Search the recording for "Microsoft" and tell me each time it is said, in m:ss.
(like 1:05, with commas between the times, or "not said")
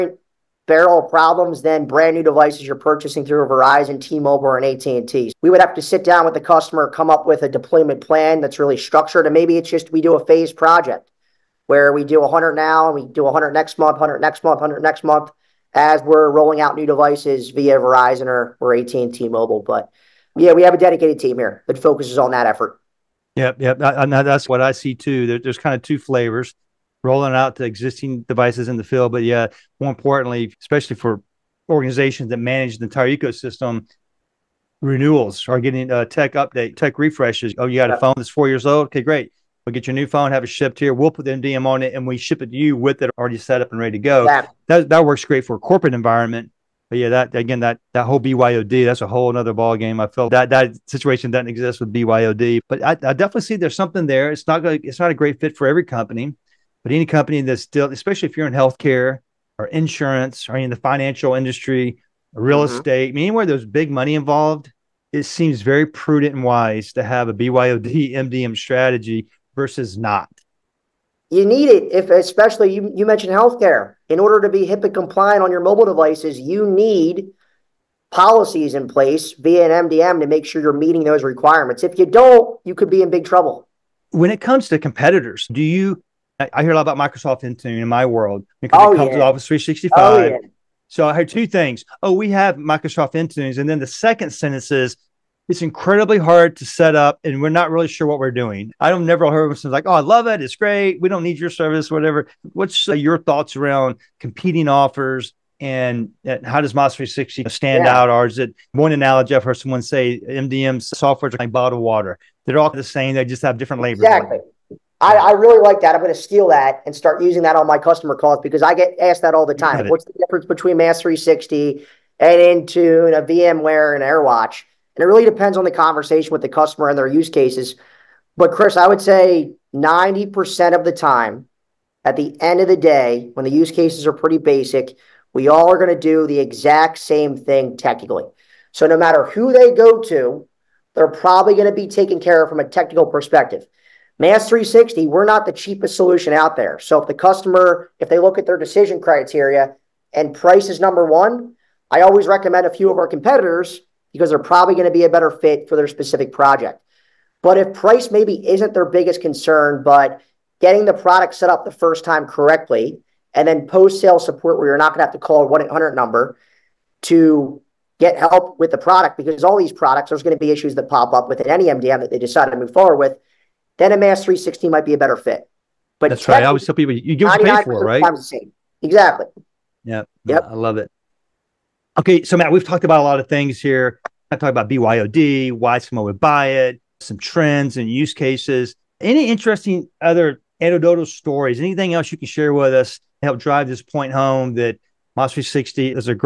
1:26, 1:32.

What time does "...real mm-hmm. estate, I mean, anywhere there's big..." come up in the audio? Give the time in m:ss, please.
1:02.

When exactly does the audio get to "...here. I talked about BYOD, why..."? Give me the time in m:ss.
3:03.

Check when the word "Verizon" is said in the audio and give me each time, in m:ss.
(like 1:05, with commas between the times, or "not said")
0:03, 0:17.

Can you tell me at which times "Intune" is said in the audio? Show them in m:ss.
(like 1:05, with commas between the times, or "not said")
1:27, 1:33, 2:02.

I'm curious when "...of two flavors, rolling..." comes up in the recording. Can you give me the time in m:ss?
0:25.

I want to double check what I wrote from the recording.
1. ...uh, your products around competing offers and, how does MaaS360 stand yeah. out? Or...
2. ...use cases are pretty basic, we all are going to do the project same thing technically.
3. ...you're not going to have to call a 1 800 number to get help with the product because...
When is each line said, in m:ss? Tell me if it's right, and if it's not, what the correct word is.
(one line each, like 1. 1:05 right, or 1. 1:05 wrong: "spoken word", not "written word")
1. 1:42 wrong: "thoughts", not "products"
2. 2:13 wrong: "exact", not "project"
3. 2:44 right.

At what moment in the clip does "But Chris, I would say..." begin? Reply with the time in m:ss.
2:08.